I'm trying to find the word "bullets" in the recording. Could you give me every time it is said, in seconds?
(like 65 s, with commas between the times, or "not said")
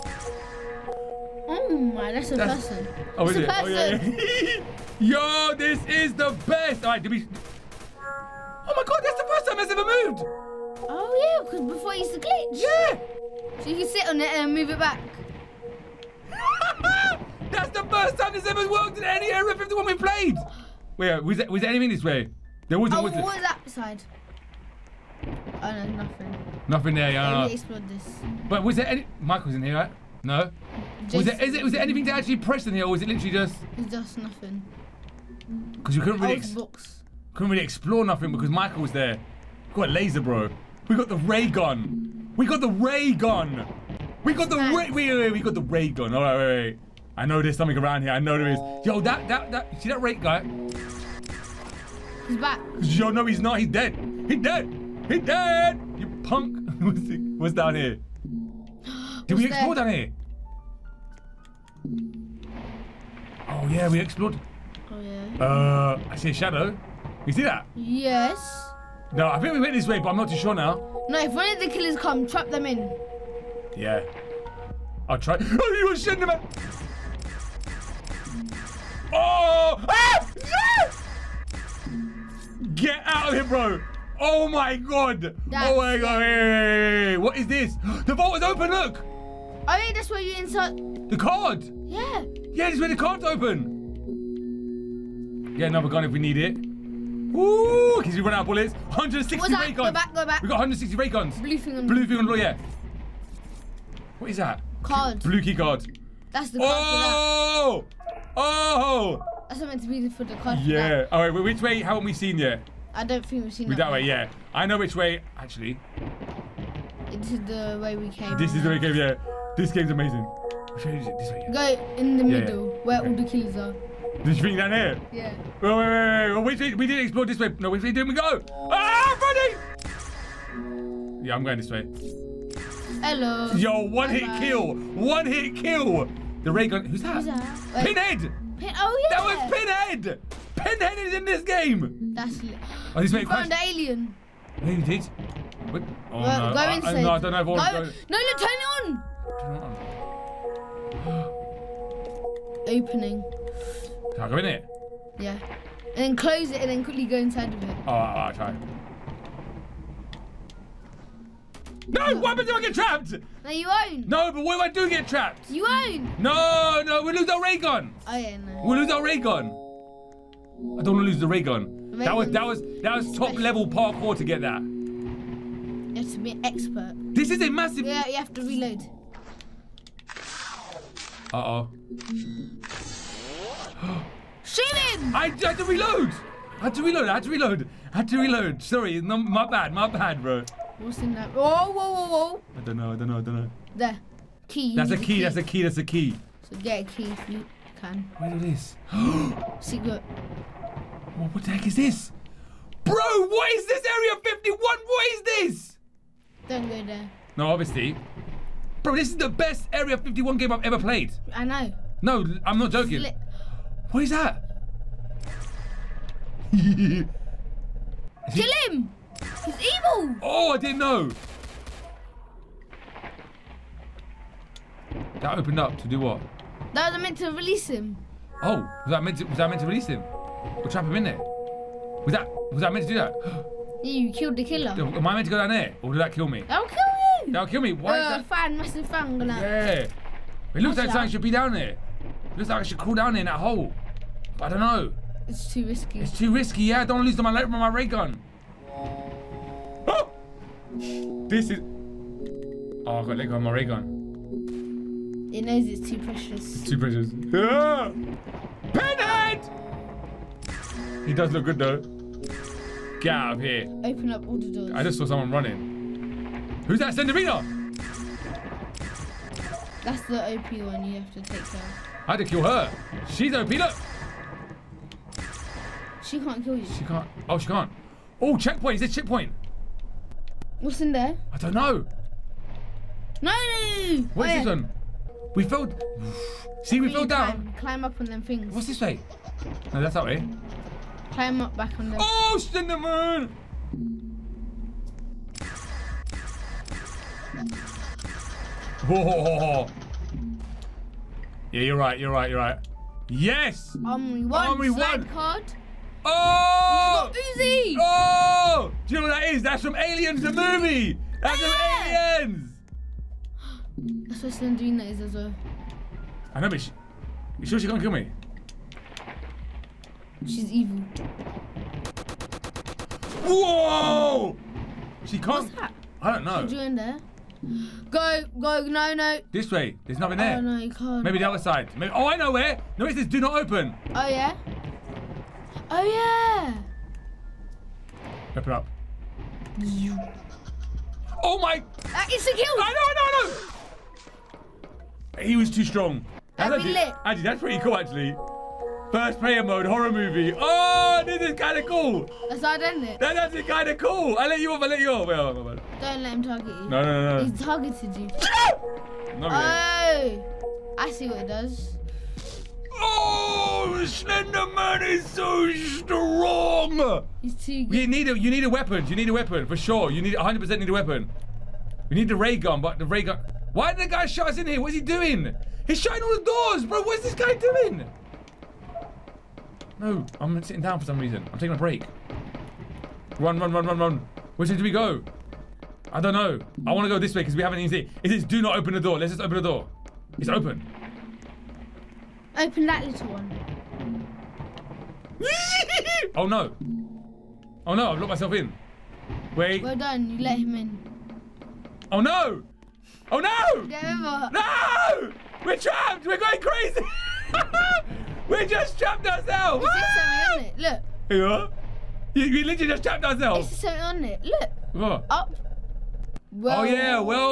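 98 s.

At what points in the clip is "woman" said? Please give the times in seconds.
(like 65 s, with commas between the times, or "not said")
not said.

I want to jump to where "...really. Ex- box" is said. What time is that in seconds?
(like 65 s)
36 s.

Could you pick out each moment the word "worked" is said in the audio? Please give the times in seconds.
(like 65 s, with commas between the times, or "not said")
18 s.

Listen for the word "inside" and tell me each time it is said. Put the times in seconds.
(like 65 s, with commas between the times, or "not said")
146 s, 157 s.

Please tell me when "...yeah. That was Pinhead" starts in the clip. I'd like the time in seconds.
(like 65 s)
139 s.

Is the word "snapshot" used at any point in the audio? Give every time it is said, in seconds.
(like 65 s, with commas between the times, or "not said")
not said.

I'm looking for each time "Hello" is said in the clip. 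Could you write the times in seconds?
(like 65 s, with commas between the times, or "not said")
133 s.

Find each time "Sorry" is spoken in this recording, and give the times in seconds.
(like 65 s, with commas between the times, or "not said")
188 s.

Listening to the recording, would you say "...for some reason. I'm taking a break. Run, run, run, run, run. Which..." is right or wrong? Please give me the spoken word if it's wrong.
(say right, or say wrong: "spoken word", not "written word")
right.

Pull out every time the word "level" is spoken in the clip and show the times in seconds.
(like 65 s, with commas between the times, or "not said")
173 s.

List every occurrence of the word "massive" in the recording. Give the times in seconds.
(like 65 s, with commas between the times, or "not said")
177 s, 238 s.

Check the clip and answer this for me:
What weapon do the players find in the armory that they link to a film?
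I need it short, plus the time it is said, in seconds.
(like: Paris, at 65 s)
Uzi, at 307 s.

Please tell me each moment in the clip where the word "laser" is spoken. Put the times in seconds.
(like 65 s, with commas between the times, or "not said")
39 s.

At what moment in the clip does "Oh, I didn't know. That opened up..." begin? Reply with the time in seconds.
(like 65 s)
220 s.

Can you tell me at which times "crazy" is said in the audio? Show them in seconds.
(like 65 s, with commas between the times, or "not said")
406 s.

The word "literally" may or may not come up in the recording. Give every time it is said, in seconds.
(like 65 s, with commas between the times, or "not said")
33 s, 412 s.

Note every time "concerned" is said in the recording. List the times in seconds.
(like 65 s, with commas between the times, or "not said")
not said.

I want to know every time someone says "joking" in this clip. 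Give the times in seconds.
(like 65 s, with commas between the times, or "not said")
212 s.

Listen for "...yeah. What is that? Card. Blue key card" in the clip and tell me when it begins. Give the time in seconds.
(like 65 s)
102 s.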